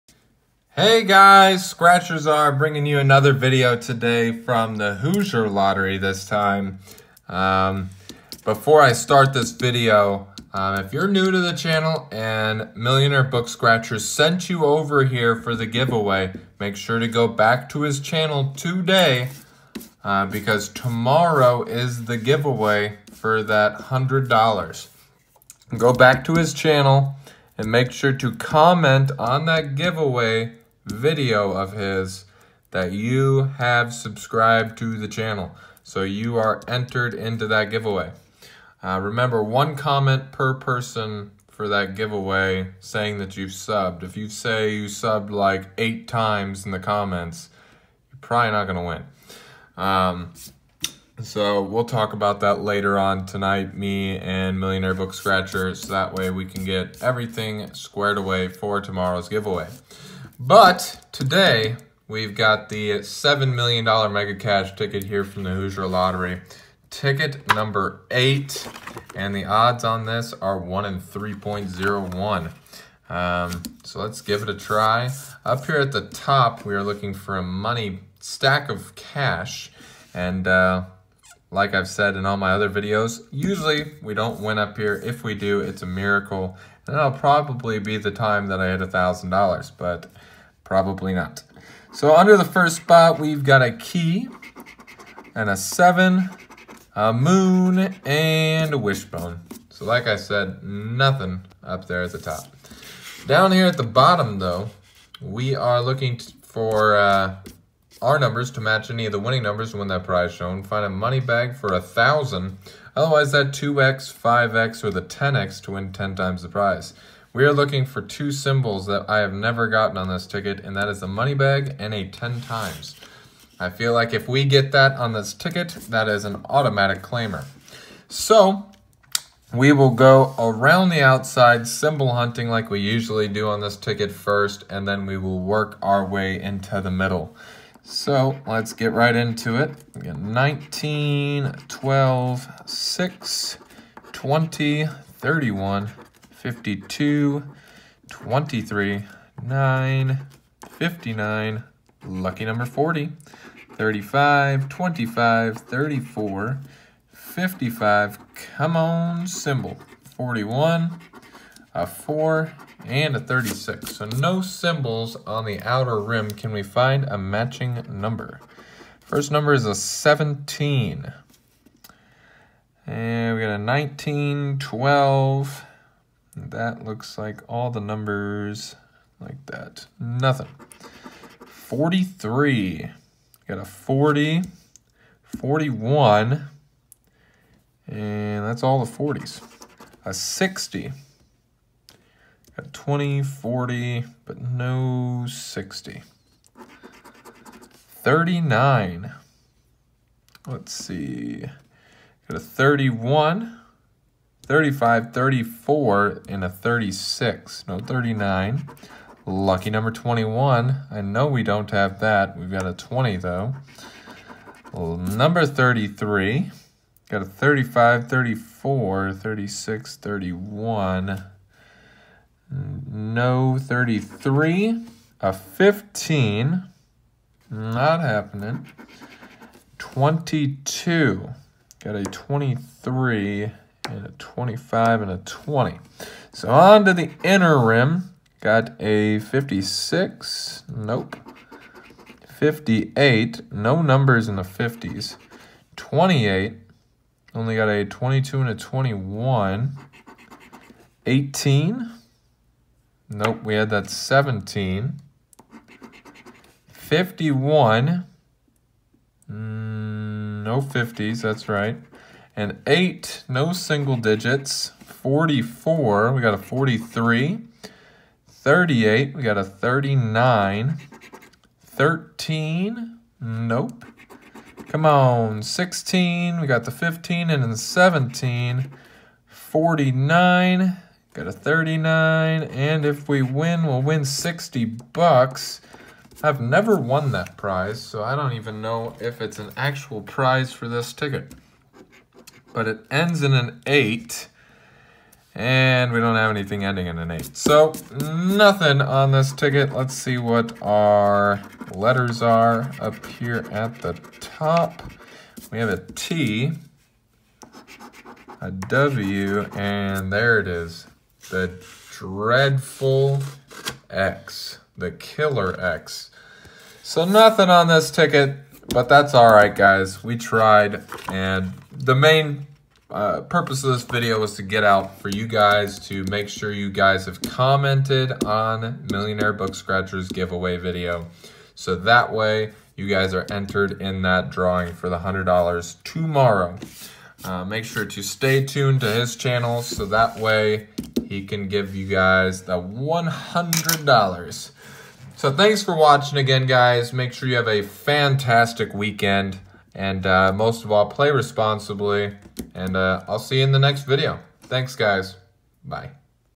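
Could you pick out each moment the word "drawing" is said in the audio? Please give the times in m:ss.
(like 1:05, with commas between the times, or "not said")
5:34.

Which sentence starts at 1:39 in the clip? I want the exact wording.
So like I said, nothing up there at the top.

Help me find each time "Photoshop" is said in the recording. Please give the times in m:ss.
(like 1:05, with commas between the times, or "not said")
not said.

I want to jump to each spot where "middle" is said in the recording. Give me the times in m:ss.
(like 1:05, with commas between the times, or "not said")
2:16.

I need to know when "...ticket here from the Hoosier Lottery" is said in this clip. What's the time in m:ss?
1:04.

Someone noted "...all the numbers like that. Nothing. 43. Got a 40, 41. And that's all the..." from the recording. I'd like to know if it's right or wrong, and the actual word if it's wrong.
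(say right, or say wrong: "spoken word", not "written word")
right.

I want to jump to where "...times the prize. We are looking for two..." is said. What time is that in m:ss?
1:56.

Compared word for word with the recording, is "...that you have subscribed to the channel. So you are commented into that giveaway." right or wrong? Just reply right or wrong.
wrong.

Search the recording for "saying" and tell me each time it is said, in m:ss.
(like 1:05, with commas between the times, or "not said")
0:42.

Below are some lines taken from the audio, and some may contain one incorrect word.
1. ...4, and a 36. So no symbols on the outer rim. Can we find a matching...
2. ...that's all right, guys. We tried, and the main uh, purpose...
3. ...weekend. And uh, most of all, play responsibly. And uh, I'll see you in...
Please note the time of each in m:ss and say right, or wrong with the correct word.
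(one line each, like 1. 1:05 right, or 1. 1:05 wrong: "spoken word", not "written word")
1. 2:41 right
2. 5:18 right
3. 5:48 right.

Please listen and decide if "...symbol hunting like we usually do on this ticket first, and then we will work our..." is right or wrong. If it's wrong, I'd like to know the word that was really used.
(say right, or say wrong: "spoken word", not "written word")
right.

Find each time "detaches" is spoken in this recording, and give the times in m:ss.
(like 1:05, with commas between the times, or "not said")
not said.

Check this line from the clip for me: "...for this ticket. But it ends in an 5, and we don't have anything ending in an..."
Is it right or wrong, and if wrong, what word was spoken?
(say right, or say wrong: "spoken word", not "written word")
wrong: "8", not "5".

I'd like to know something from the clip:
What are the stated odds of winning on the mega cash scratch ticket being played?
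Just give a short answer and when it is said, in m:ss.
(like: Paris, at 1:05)
1 in 3.01, at 1:10.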